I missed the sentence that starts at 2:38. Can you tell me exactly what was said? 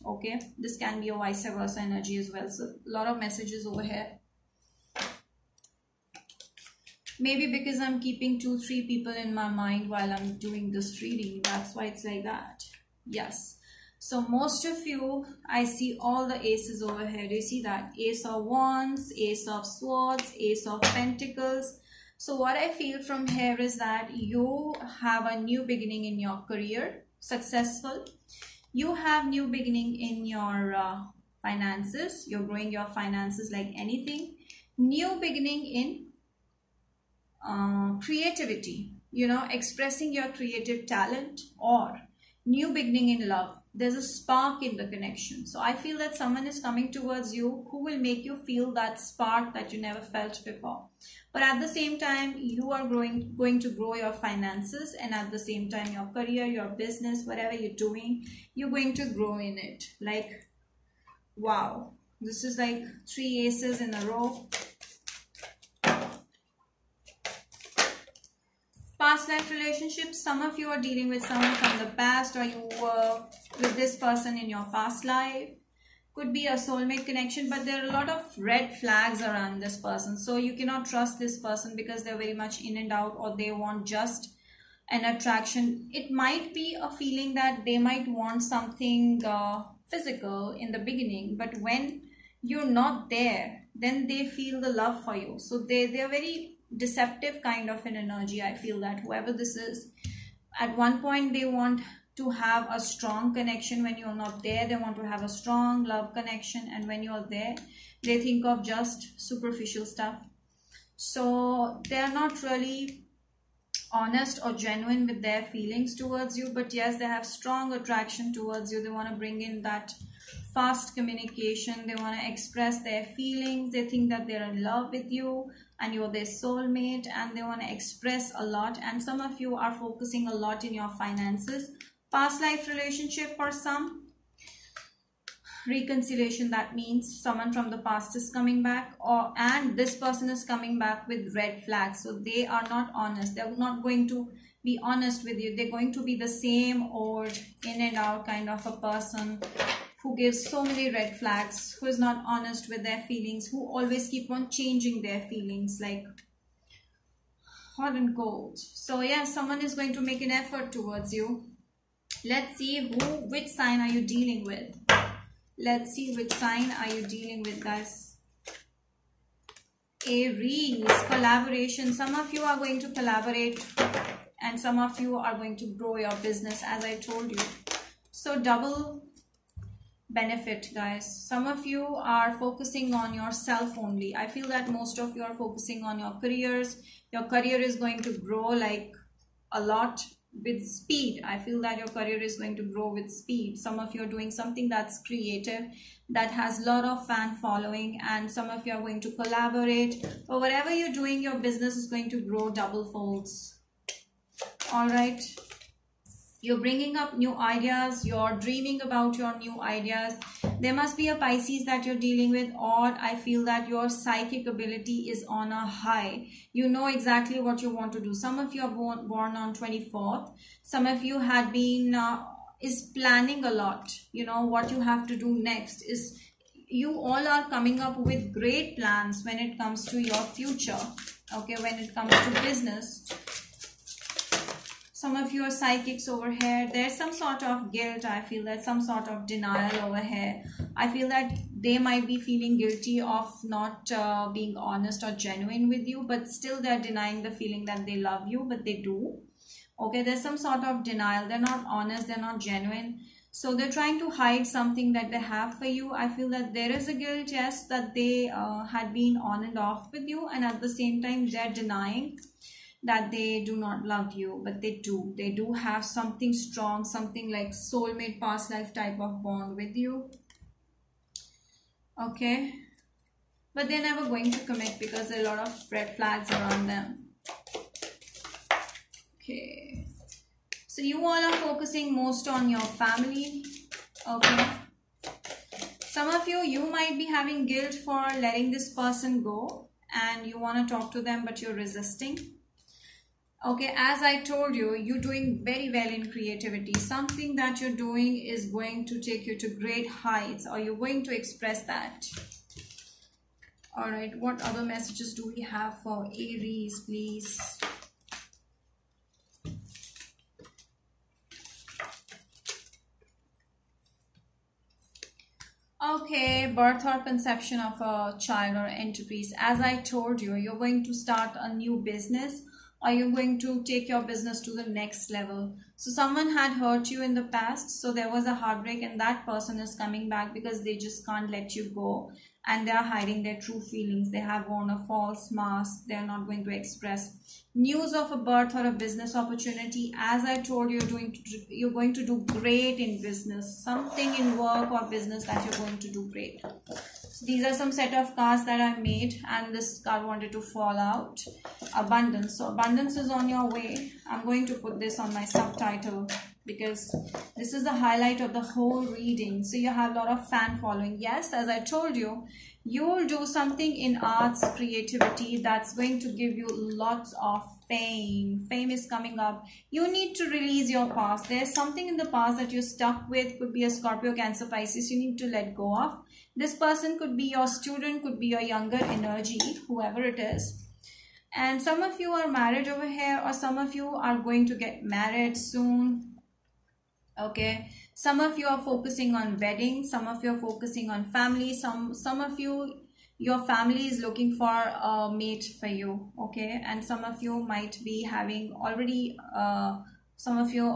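So yeah, someone is going to make an effort towards you.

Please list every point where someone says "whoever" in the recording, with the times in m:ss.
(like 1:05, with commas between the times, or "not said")
1:38, 6:19.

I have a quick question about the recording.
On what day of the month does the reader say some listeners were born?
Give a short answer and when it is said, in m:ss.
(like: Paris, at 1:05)
24th, at 3:39.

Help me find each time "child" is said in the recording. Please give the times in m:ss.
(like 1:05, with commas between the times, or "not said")
5:18.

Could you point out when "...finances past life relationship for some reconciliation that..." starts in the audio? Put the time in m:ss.
2:10.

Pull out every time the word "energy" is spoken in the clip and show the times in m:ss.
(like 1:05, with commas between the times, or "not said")
0:01, 1:37, 6:18.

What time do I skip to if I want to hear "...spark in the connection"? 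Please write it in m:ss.
0:44.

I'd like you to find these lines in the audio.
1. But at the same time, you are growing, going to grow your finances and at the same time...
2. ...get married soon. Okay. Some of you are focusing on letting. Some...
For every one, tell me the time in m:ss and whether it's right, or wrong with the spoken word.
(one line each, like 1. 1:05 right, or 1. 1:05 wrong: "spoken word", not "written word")
1. 0:51 right
2. 6:24 wrong: "wedding", not "letting".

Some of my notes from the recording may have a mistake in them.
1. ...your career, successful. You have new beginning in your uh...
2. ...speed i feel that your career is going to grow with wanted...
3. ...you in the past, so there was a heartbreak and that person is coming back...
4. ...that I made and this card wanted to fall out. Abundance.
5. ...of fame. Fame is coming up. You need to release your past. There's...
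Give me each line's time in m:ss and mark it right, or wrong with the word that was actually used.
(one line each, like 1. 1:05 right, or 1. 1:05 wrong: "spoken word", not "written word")
1. 0:26 right
2. 3:10 wrong: "speed", not "wanted"
3. 5:26 right
4. 5:48 right
5. 6:07 right.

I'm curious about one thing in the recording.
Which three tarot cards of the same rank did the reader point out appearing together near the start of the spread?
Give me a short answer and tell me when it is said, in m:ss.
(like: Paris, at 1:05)
Ace of Wands, Ace of Swords, Ace of Pentacles, at 0:17.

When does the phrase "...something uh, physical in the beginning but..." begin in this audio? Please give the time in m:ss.
1:28.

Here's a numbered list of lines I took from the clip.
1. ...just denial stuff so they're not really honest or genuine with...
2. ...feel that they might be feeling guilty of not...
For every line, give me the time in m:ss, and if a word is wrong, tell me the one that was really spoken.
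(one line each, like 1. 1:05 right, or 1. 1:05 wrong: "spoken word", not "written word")
1. 1:48 wrong: "superficial", not "denial"
2. 4:00 right.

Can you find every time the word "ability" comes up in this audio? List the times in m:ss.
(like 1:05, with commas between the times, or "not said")
3:34.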